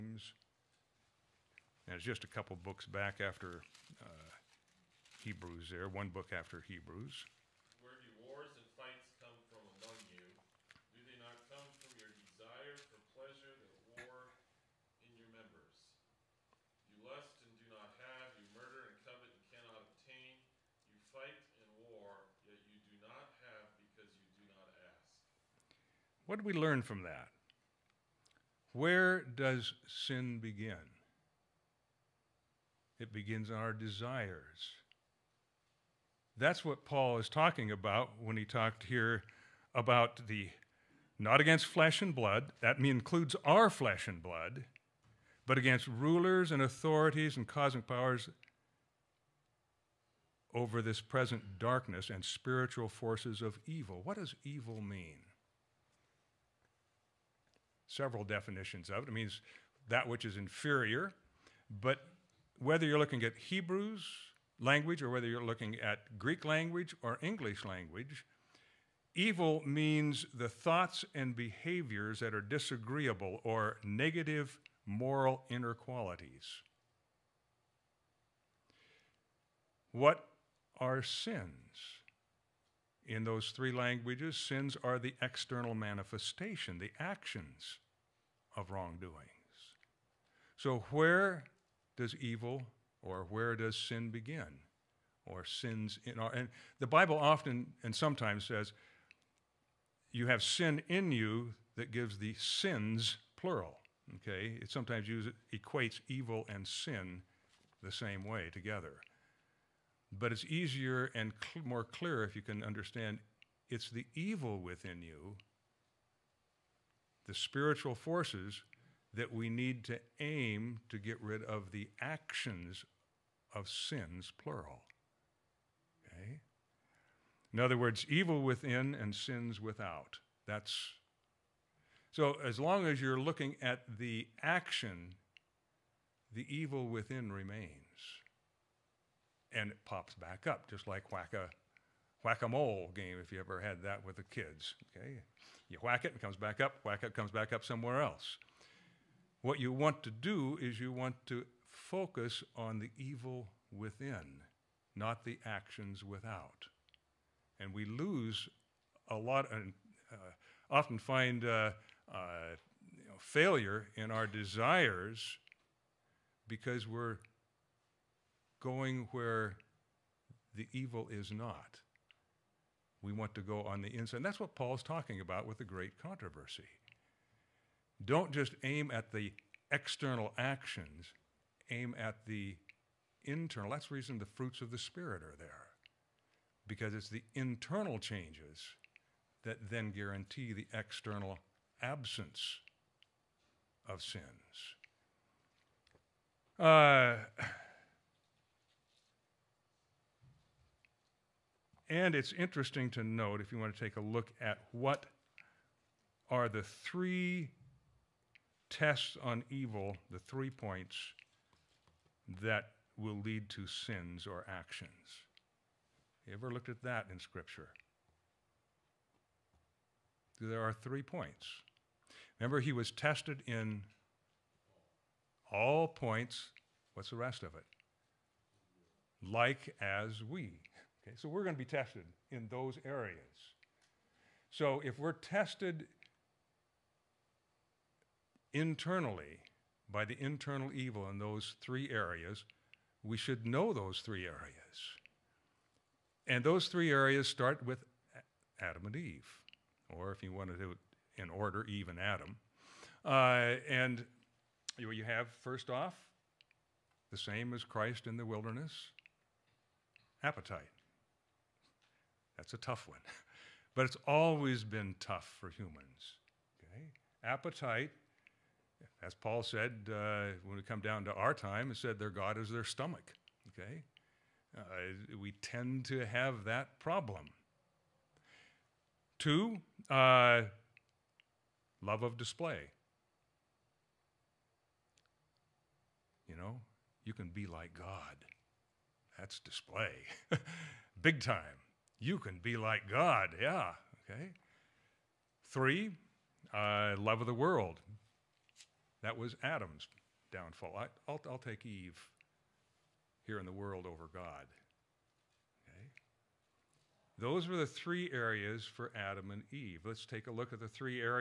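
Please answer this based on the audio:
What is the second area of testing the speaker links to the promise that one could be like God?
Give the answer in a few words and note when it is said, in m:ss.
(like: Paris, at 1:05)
Love of display, at 4:41.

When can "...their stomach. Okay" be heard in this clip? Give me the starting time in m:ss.
4:32.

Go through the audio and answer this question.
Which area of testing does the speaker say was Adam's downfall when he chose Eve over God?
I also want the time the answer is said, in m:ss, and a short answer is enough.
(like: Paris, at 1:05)
Love of the world, at 4:56.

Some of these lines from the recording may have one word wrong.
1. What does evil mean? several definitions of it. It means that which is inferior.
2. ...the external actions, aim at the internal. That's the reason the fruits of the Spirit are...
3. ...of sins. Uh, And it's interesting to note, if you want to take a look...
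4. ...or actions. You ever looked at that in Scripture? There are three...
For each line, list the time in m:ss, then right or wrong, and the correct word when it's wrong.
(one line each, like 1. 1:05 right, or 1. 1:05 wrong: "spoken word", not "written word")
1. 0:54 right
2. 2:59 right
3. 3:13 right
4. 3:34 right.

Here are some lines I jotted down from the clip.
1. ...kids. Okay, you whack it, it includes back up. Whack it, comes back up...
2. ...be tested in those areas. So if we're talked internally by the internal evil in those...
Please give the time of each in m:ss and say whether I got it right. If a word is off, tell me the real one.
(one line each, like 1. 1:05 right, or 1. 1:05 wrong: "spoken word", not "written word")
1. 2:24 wrong: "comes", not "includes"
2. 3:51 wrong: "tested", not "talked".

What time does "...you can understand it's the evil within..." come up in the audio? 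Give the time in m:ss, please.
1:52.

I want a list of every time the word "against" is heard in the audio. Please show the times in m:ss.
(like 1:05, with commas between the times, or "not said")
0:41, 0:45.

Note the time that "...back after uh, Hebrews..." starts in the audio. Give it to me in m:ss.
0:02.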